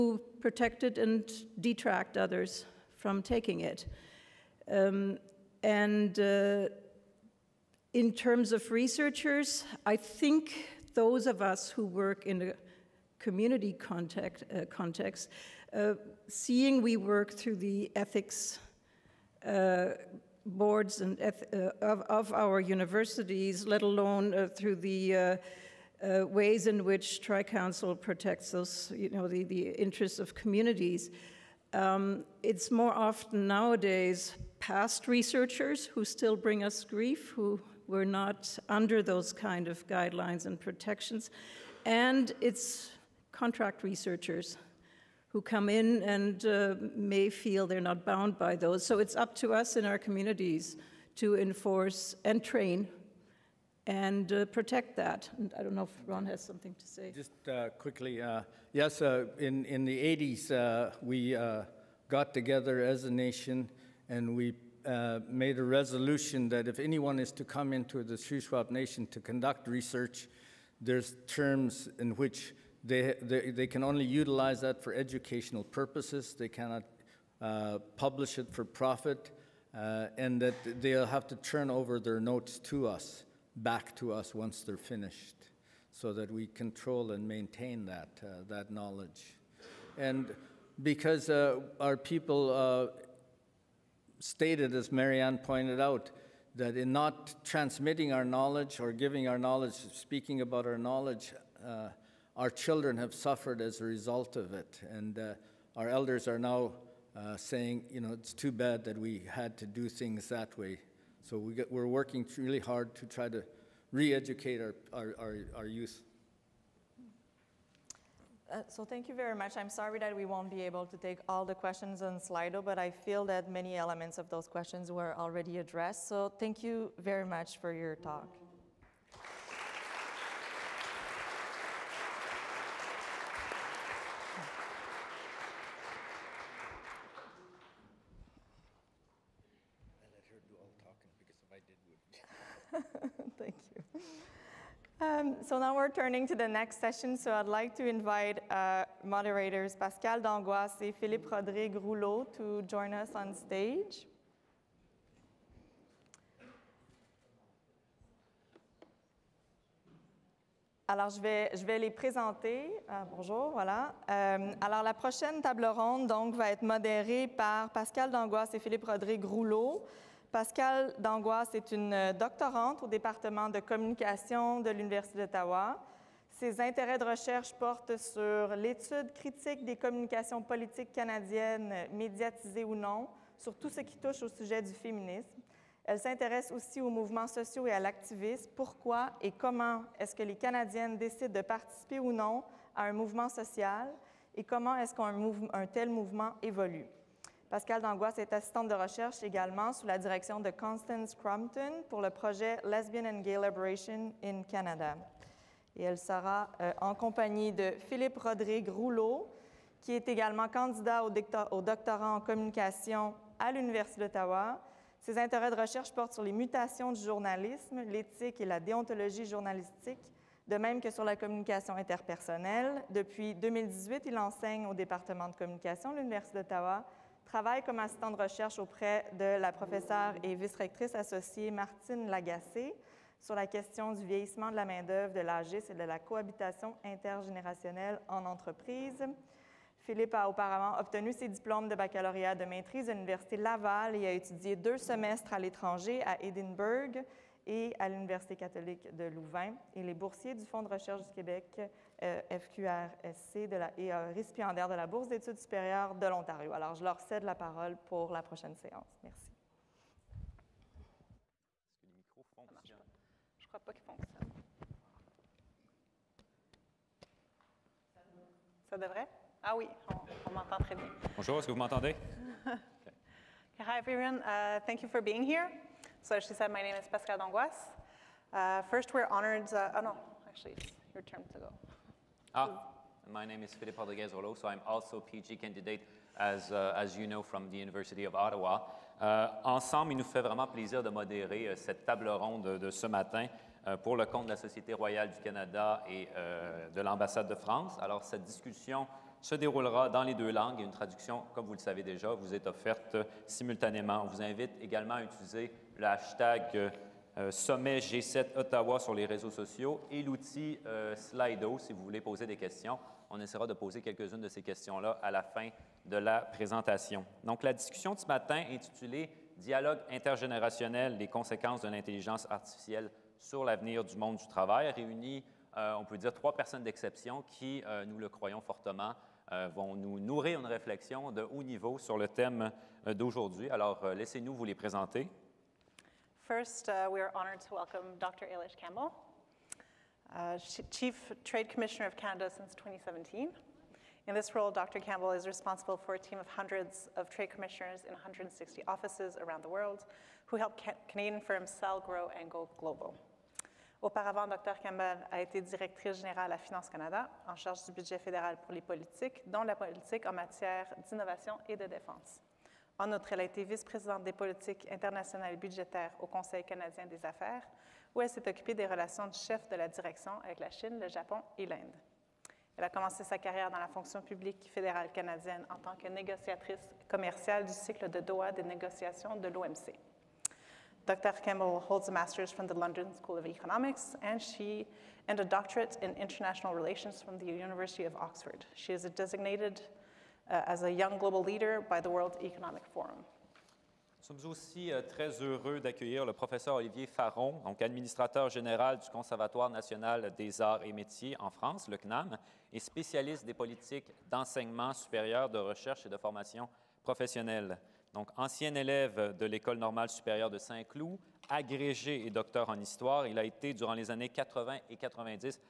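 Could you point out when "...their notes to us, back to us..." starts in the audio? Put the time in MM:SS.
01:21.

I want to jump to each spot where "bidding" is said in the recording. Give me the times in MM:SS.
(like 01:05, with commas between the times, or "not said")
not said.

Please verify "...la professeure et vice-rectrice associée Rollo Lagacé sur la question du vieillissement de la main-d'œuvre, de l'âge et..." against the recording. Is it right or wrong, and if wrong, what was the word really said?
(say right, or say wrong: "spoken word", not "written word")
wrong: "Martine", not "Rollo".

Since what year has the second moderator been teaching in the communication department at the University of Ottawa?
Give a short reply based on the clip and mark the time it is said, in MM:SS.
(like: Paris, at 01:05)
2018, at 03:43.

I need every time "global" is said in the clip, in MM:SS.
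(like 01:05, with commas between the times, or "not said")
05:52, 06:30.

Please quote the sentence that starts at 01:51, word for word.
So we get, we're working really hard to try to re educate our, our, our, our youth.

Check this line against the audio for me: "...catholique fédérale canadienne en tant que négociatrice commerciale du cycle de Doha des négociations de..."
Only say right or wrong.
wrong.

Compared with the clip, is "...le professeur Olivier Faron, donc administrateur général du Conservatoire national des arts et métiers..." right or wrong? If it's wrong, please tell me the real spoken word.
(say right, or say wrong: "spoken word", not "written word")
right.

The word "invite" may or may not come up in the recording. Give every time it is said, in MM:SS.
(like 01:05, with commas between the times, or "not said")
02:27, 05:04.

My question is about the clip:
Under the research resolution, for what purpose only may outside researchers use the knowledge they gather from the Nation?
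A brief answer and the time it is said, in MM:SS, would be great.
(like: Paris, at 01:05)
Educational purposes, at 01:14.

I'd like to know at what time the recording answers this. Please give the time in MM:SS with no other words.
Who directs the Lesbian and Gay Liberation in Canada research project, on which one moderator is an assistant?
03:20.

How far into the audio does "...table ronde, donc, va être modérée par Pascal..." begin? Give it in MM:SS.
02:45.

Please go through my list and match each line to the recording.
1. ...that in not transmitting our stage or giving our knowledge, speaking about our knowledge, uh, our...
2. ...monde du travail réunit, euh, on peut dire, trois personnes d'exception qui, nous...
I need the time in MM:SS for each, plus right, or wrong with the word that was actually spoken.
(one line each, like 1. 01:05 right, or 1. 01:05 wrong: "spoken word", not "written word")
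1. 01:36 wrong: "knowledge", not "stage"
2. 05:23 right.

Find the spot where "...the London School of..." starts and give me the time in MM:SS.
06:22.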